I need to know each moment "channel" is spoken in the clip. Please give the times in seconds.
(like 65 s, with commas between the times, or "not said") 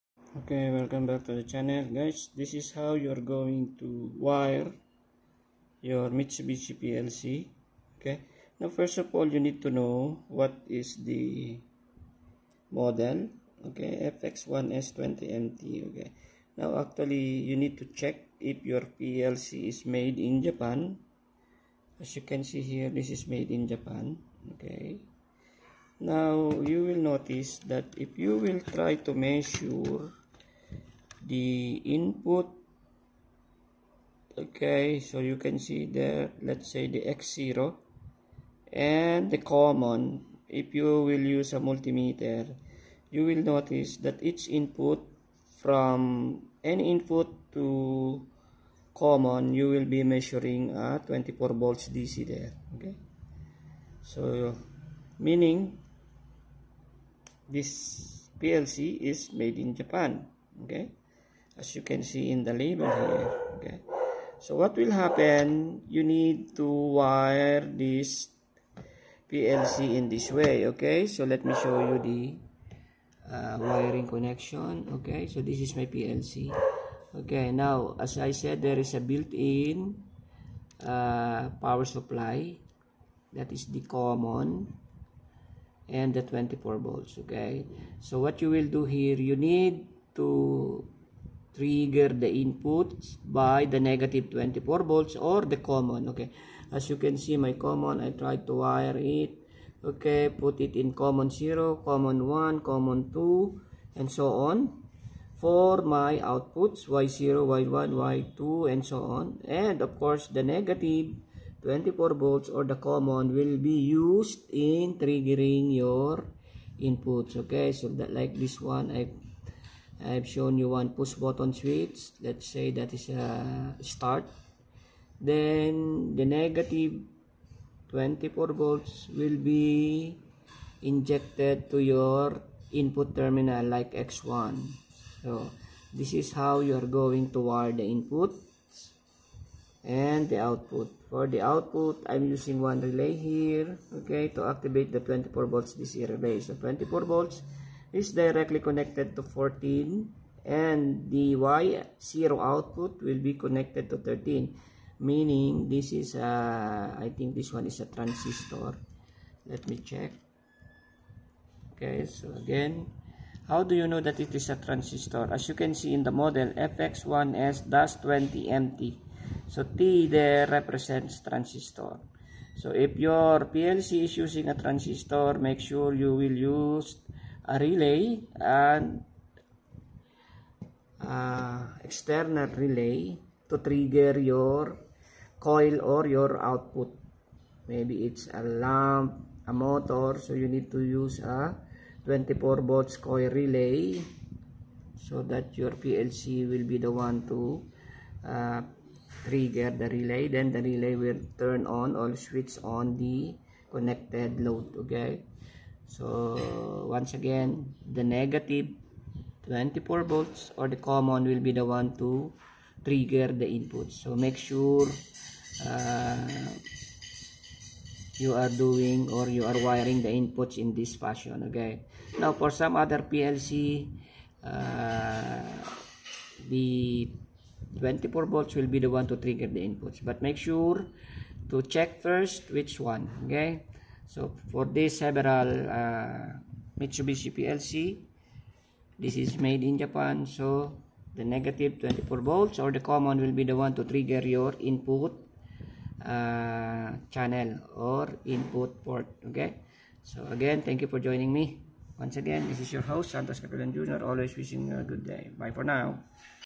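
1 s, 247 s.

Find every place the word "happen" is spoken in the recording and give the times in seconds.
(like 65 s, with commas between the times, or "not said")
64 s.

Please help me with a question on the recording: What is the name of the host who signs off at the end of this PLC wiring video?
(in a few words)
Santos Catalan Jr.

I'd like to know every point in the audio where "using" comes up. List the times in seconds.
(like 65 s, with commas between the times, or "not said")
142 s, 174 s.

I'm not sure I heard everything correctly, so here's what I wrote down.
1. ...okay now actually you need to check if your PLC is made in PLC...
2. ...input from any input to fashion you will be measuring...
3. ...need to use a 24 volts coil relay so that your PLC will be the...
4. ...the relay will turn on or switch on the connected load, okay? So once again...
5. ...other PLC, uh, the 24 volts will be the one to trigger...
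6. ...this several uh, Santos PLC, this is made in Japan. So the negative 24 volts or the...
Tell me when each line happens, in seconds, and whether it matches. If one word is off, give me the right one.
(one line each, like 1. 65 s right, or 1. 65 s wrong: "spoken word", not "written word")
1. 15 s wrong: "Japan", not "PLC"
2. 44 s wrong: "common", not "fashion"
3. 190 s right
4. 200 s right
5. 222 s right
6. 234 s wrong: "Mitsubishi", not "Santos".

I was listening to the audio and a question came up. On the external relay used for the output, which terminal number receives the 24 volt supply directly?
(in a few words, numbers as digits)
14.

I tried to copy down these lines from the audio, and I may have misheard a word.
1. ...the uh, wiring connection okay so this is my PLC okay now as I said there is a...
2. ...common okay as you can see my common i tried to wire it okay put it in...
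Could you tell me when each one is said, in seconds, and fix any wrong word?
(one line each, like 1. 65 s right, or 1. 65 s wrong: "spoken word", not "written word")
1. 71 s right
2. 95 s right.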